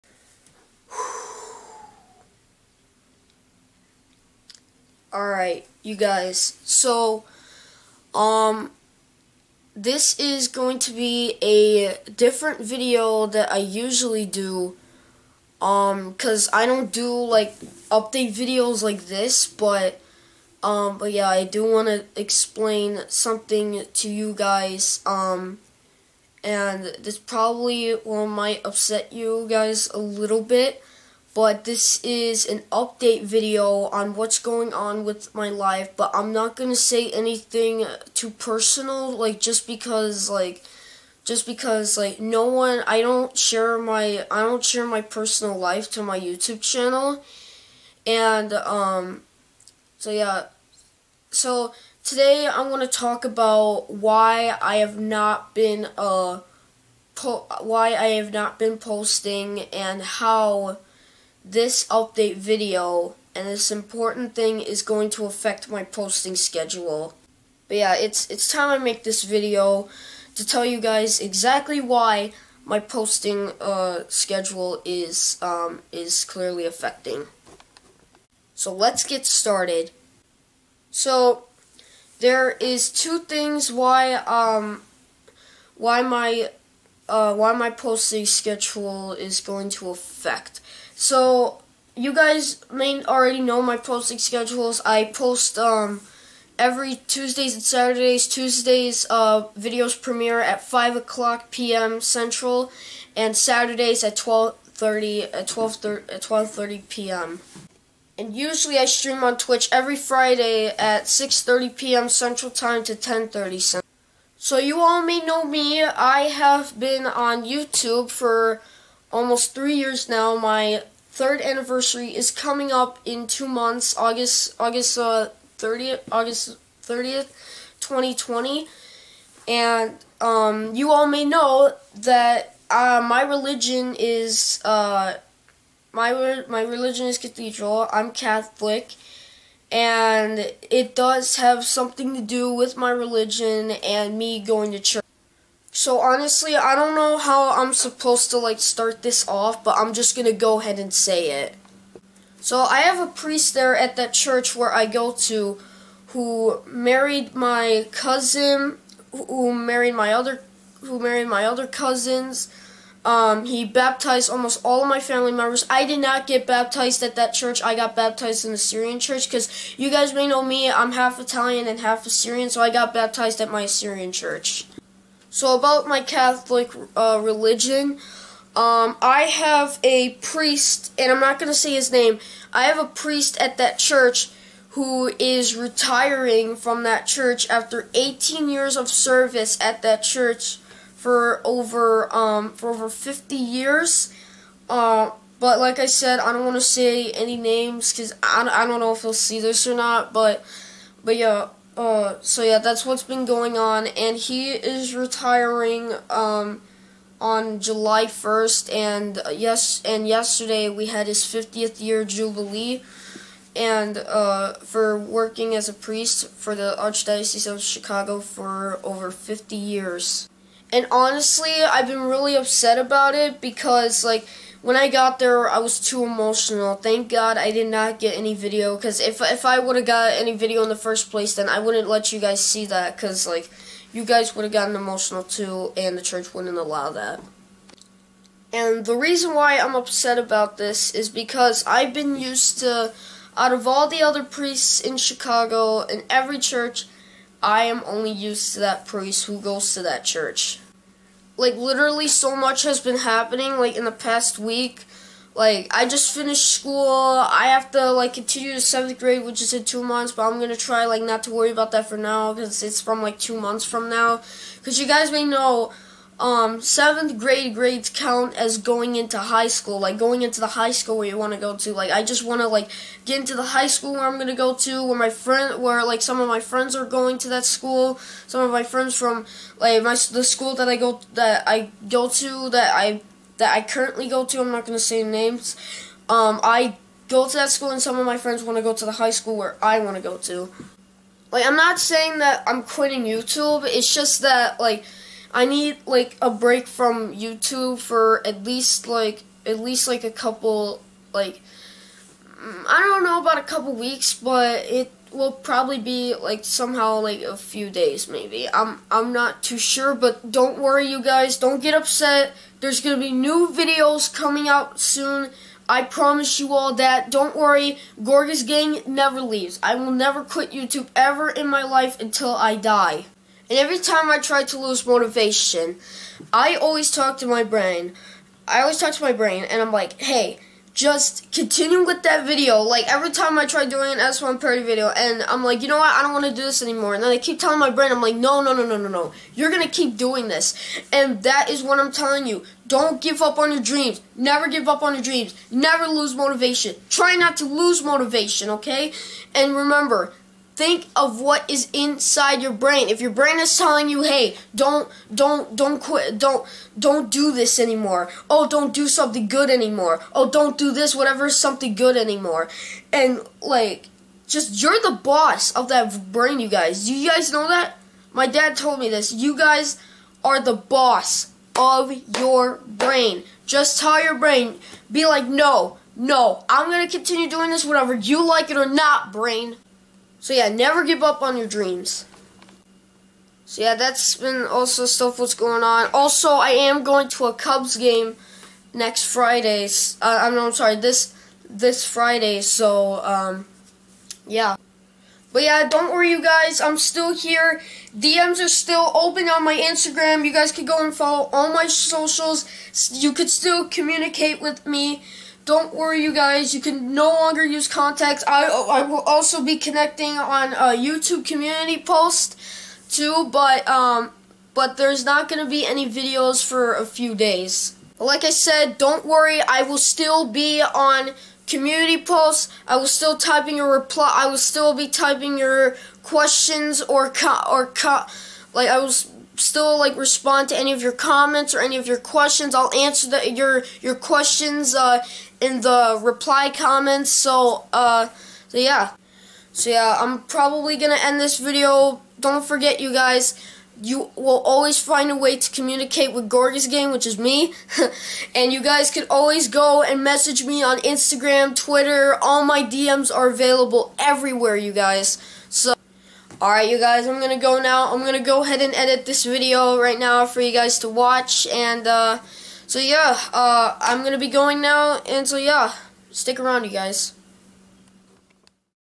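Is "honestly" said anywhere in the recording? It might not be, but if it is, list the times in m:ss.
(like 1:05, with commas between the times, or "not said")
2:26, 3:40.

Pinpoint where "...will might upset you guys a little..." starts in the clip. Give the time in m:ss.
0:28.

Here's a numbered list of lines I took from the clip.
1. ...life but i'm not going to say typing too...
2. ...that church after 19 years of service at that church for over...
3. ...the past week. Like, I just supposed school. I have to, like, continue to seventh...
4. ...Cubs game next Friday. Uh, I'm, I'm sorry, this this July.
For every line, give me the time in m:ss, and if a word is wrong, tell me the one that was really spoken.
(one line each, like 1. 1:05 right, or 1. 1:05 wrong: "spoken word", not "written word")
1. 0:35 wrong: "anything", not "typing"
2. 3:06 wrong: "18", not "19"
3. 4:13 wrong: "finished", not "supposed"
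4. 6:27 wrong: "Friday", not "July".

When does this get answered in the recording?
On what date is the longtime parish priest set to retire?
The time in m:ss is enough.
3:27.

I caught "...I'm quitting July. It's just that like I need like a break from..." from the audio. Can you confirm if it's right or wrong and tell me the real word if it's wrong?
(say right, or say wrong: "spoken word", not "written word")
wrong: "YouTube", not "July".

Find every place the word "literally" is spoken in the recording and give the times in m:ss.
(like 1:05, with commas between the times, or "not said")
4:11.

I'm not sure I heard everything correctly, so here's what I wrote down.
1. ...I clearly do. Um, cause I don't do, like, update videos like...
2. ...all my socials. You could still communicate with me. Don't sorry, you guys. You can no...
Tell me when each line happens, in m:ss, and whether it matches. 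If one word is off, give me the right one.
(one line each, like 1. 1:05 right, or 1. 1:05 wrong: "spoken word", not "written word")
1. 0:13 wrong: "usually", not "clearly"
2. 6:41 wrong: "worry", not "sorry".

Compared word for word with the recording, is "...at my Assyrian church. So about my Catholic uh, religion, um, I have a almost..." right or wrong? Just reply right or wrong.
wrong.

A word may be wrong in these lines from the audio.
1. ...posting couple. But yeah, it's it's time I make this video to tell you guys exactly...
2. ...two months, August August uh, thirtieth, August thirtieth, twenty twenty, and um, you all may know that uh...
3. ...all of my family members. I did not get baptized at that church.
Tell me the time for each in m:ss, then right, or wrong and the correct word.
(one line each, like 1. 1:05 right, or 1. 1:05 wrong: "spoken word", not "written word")
1. 1:05 wrong: "schedule", not "couple"
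2. 2:03 right
3. 2:44 right.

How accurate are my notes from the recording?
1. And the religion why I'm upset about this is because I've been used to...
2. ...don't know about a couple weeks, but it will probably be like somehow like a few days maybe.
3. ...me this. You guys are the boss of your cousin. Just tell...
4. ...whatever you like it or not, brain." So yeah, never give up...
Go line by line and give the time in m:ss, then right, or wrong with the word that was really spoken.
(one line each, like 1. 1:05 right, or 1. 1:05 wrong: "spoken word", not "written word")
1. 3:58 wrong: "reason", not "religion"
2. 5:02 right
3. 6:08 wrong: "brain", not "cousin"
4. 6:17 right.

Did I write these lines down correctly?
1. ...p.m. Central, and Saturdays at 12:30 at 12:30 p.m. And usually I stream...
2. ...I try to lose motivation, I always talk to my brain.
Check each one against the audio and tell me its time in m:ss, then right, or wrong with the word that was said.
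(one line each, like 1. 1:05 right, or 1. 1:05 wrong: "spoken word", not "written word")
1. 1:41 right
2. 5:24 right.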